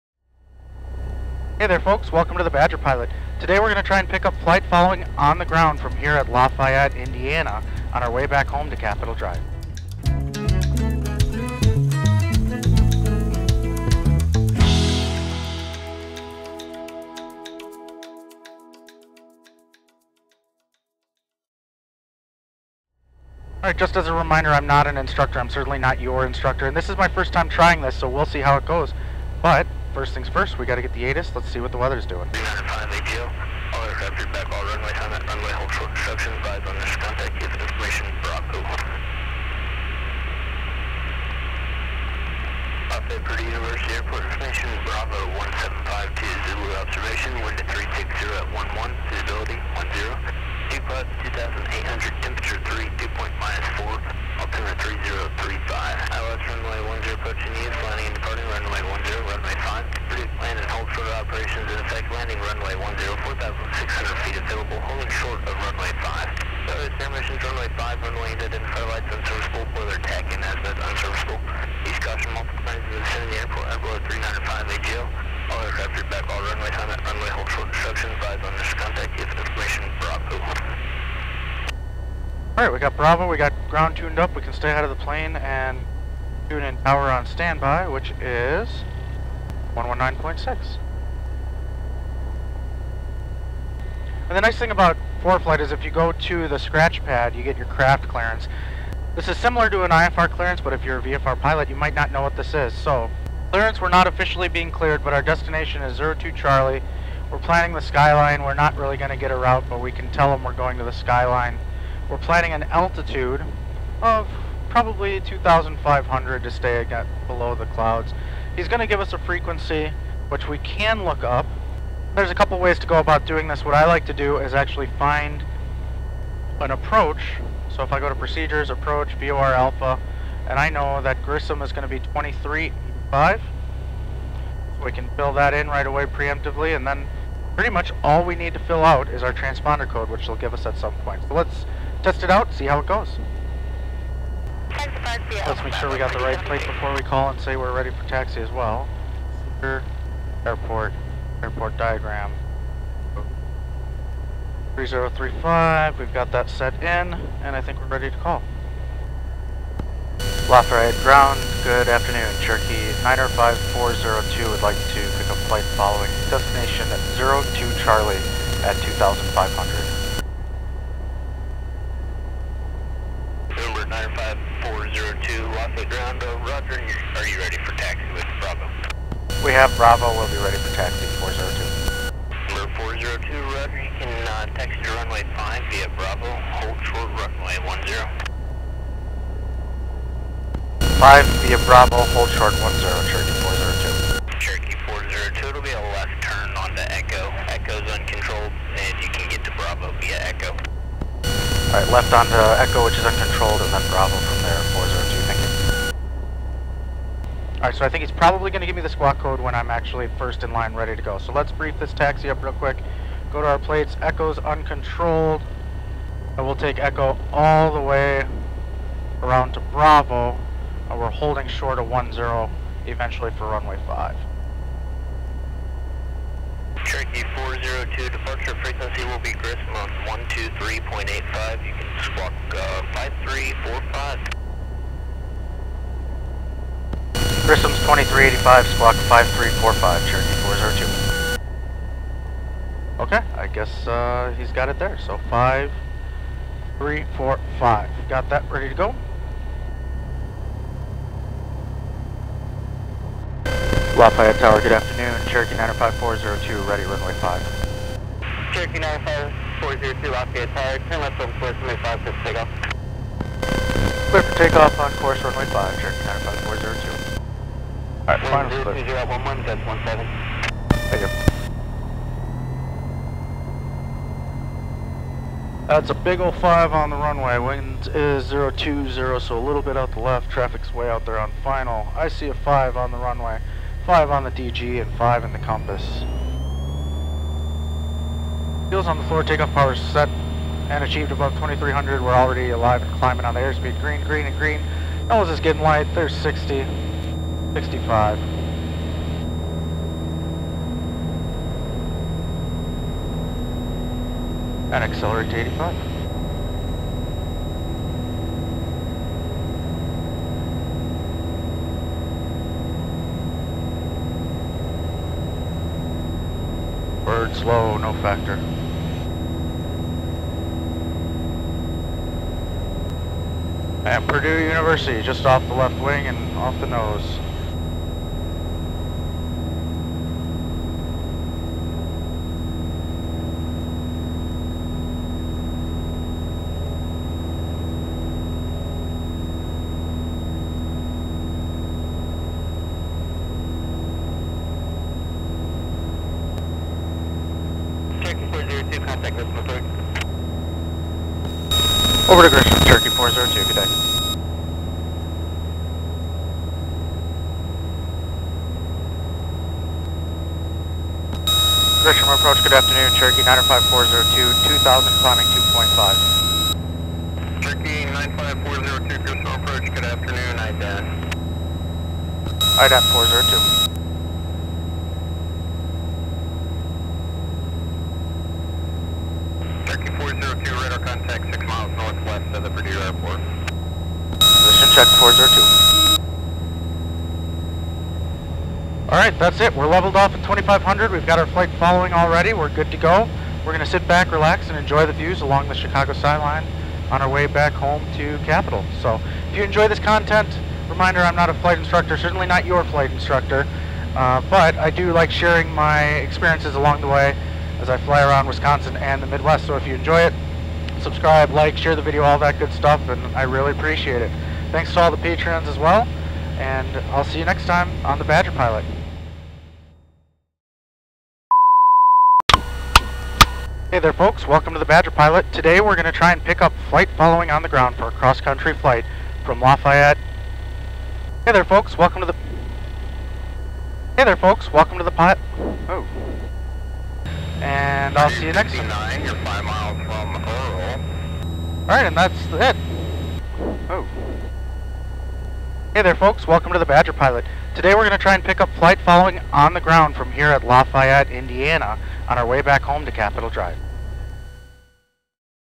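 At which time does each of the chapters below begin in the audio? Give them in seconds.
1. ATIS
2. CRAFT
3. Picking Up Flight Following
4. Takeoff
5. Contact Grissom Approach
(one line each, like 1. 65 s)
1. 30 s
2. 95 s
3. 159 s
4. 250 s
5. 345 s.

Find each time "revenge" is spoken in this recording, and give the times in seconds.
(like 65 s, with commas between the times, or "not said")
not said.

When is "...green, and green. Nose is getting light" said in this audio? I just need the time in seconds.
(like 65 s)
294 s.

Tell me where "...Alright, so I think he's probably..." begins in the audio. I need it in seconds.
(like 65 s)
207 s.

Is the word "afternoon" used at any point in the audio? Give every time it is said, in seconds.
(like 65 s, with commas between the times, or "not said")
161 s, 254 s, 362 s, 369 s.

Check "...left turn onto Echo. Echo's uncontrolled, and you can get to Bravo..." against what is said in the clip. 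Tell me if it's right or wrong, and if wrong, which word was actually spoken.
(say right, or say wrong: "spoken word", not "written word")
right.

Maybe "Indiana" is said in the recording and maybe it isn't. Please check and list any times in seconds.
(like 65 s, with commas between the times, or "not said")
6 s, 451 s.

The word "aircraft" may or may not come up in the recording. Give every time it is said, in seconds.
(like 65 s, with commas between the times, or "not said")
75 s.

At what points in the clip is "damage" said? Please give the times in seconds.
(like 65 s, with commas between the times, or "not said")
66 s.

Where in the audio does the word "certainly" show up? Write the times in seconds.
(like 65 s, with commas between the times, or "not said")
25 s, 401 s.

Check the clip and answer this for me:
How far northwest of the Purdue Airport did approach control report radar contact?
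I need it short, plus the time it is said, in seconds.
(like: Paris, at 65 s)
6 miles, at 381 s.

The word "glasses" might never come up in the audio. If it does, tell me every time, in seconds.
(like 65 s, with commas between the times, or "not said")
not said.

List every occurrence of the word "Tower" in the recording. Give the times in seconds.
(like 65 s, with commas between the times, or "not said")
254 s, 260 s.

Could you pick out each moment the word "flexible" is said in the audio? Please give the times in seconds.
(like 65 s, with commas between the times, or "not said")
not said.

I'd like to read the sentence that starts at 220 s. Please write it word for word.
And we're holding short of 1-0 eventually for runway 5.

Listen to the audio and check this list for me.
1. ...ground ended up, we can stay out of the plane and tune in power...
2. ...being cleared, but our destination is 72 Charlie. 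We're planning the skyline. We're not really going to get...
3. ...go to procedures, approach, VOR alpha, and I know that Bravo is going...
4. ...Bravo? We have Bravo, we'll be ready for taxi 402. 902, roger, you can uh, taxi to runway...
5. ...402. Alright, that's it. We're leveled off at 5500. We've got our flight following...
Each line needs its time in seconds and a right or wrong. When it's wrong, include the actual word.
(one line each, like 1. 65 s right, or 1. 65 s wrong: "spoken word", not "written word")
1. 83 s wrong: "tuned", not "ended"
2. 104 s wrong: "02", not "72"
3. 128 s wrong: "Grissom", not "Bravo"
4. 178 s wrong: "402", not "902"
5. 384 s wrong: "2500", not "5500".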